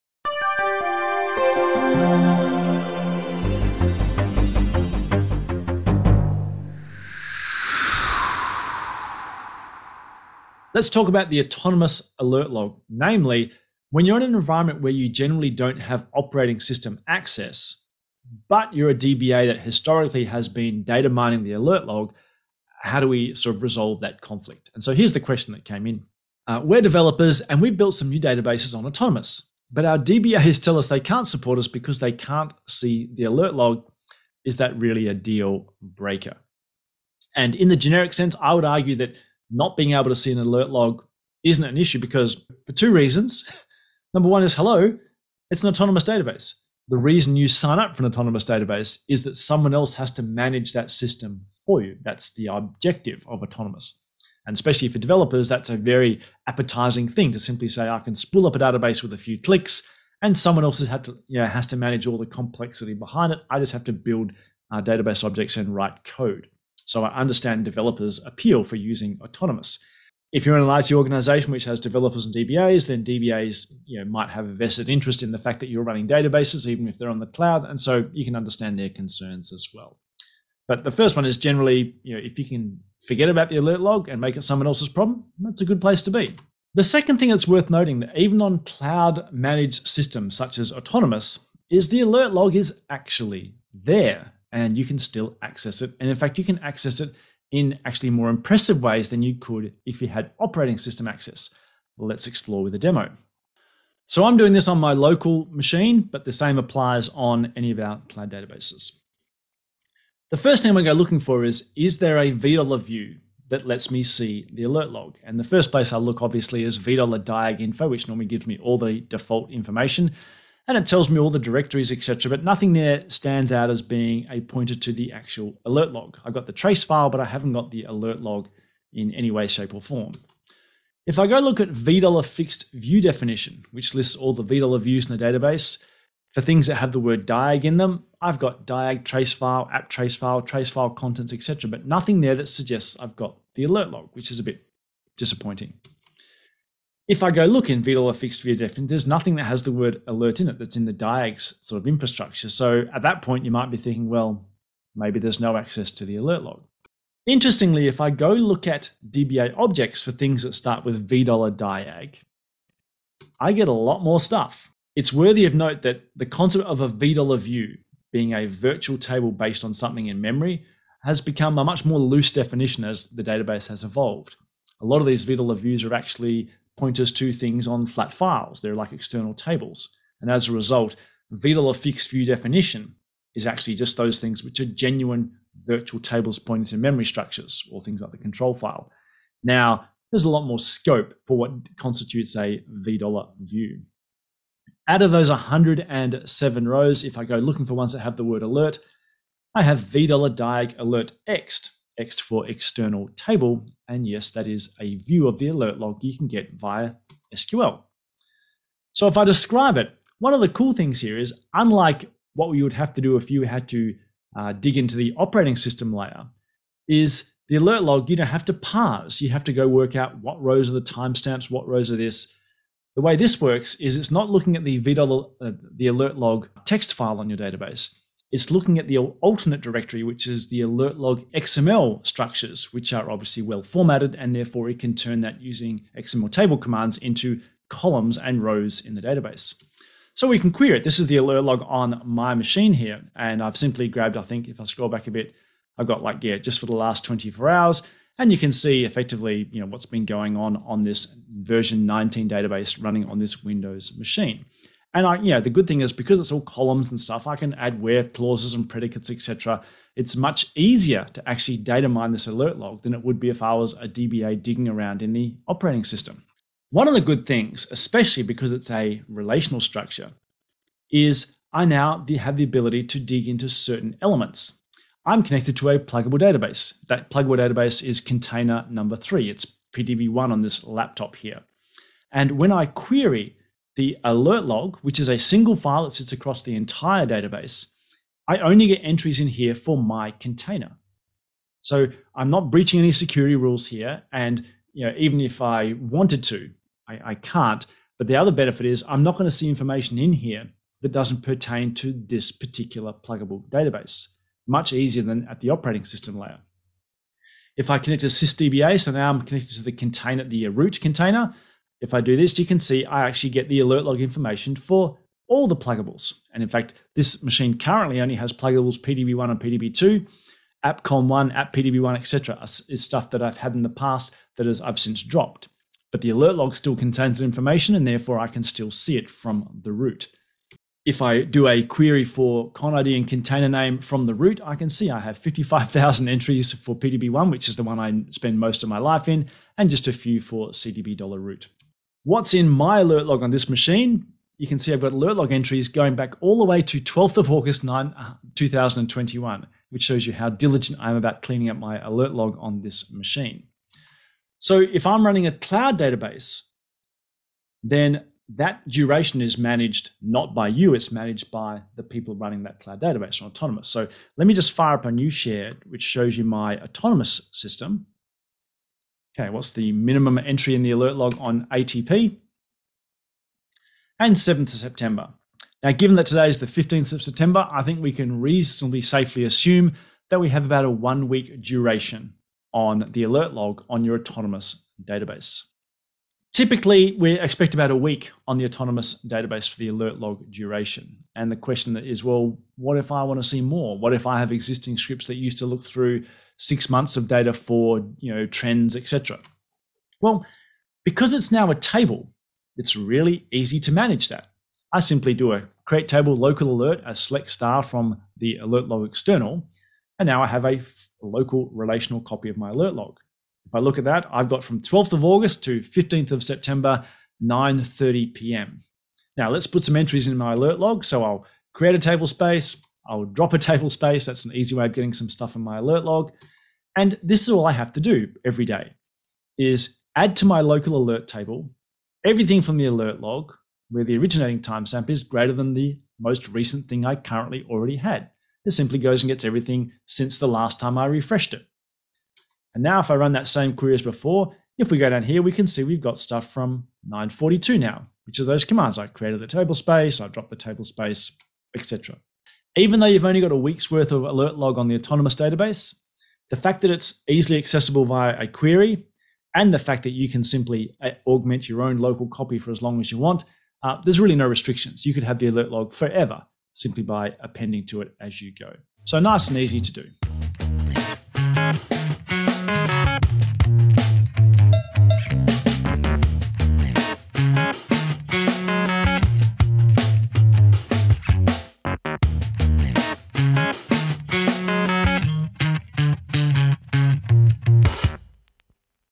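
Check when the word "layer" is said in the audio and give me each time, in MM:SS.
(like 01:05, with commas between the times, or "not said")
03:35, 05:06.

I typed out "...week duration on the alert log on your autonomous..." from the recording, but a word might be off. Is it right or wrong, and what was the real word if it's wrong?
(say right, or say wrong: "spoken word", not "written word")
right.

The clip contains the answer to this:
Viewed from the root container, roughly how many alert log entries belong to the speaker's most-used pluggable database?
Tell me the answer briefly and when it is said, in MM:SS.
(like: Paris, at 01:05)
55,000, at 05:35.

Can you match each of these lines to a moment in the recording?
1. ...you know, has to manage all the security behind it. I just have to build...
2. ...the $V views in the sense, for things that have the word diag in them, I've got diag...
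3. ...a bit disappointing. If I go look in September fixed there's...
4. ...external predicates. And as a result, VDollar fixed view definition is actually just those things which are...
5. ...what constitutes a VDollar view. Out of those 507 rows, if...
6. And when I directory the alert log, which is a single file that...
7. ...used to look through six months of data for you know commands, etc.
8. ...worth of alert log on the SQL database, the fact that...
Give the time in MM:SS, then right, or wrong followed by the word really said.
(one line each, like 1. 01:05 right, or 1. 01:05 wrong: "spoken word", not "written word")
1. 01:01 wrong: "complexity", not "security"
2. 02:14 wrong: "database", not "sense"
3. 02:24 wrong: "VDollar", not "September"
4. 02:58 wrong: "tables", not "predicates"
5. 03:11 wrong: "107", not "507"
6. 04:42 wrong: "query", not "directory"
7. 06:35 wrong: "trends", not "commands"
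8. 07:33 wrong: "Autonomous", not "SQL".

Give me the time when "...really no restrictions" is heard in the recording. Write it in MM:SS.
07:43.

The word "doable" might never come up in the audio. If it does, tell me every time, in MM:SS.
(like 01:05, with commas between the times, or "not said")
not said.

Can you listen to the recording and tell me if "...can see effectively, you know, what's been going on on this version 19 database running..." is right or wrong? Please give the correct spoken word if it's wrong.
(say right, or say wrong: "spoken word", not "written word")
right.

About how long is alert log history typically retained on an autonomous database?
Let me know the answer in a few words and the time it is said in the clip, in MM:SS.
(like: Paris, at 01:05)
About a week, at 06:27.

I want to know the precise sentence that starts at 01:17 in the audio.
And so you can understand their concerns as well.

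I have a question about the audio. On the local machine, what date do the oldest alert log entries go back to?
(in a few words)
12th of August 2021.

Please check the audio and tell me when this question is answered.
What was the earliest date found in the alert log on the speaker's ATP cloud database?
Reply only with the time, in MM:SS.
06:14.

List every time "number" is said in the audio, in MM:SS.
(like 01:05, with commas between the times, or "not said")
00:44, 04:38.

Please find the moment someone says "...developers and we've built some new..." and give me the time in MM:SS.
00:26.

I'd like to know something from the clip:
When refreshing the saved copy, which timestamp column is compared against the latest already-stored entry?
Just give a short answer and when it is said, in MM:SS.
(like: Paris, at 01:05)
originating timestamp, at 07:13.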